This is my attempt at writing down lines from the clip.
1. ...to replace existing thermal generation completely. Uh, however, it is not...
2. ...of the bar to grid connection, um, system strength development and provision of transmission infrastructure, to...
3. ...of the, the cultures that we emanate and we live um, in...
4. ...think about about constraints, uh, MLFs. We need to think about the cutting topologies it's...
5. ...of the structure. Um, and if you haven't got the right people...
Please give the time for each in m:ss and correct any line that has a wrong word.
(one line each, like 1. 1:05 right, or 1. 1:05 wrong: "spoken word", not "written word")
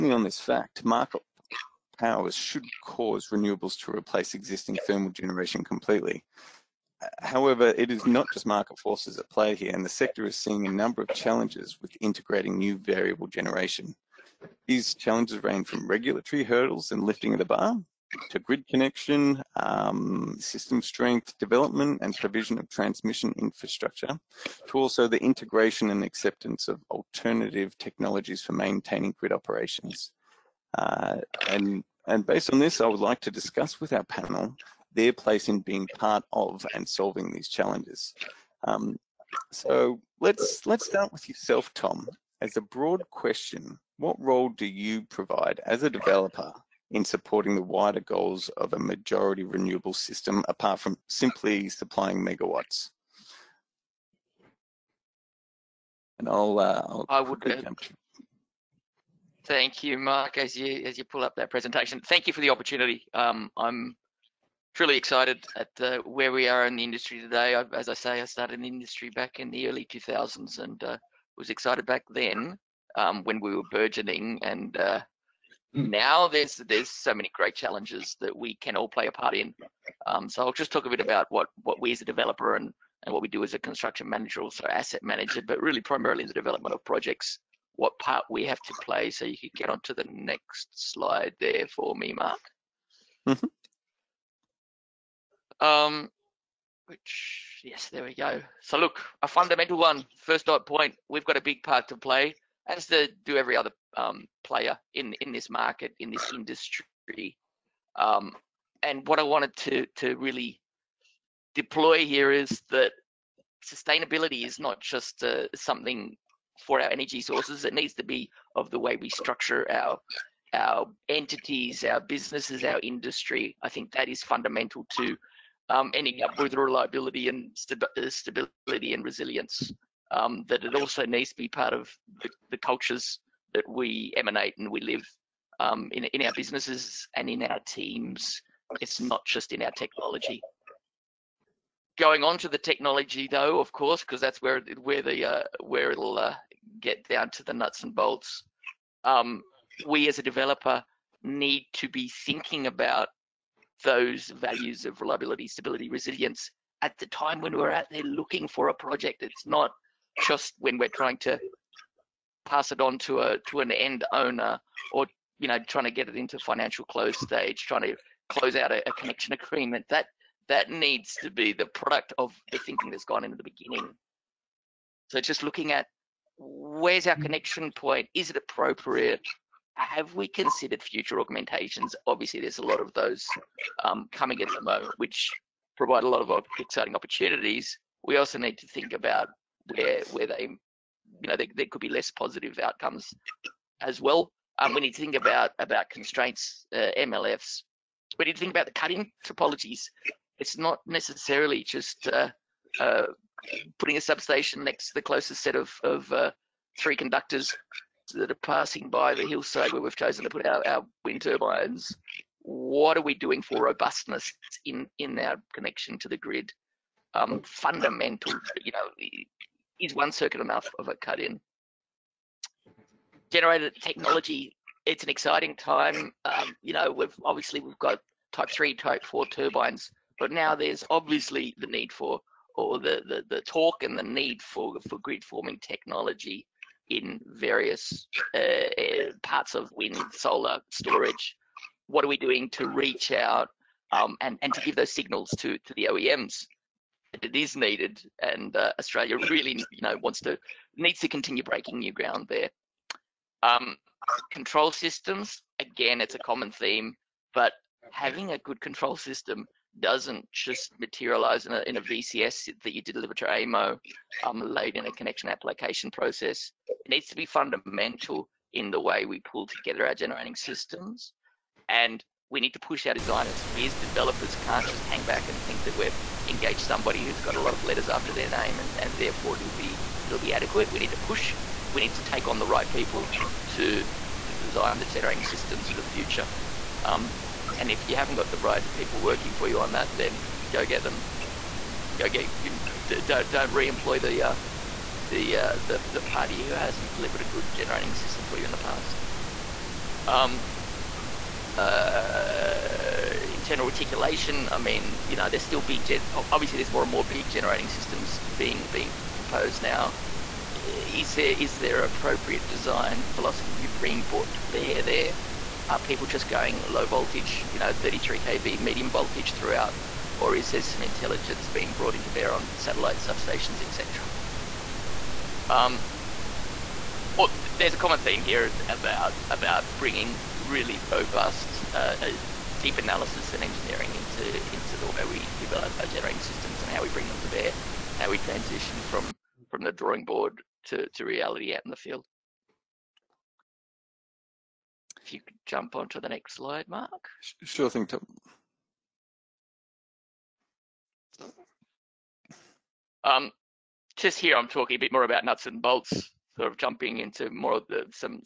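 1. 0:03 right
2. 0:17 right
3. 2:11 right
4. 3:15 right
5. 4:45 wrong: "future", not "structure".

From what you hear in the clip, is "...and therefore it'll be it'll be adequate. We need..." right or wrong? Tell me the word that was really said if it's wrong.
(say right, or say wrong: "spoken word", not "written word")
right.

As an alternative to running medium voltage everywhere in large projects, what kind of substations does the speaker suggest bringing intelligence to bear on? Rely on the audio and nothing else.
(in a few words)
satellite substations.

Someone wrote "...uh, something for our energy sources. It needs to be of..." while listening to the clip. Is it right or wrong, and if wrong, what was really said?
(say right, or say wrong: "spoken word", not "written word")
right.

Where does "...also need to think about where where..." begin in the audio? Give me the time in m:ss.
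3:08.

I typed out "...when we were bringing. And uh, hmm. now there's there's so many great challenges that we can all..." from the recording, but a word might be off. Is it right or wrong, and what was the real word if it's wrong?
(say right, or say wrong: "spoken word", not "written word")
wrong: "burgeoning", not "bringing".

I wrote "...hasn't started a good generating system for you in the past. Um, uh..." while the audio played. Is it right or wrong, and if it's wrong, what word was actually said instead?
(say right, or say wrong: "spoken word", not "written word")
wrong: "delivered", not "started".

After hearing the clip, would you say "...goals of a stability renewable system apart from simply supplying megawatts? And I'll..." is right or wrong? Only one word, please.
wrong.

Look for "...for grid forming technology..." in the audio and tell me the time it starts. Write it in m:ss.
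3:54.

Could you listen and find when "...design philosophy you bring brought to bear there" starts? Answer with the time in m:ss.
5:12.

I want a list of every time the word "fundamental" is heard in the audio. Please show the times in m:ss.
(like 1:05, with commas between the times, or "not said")
1:39, 2:04, 3:37, 4:27.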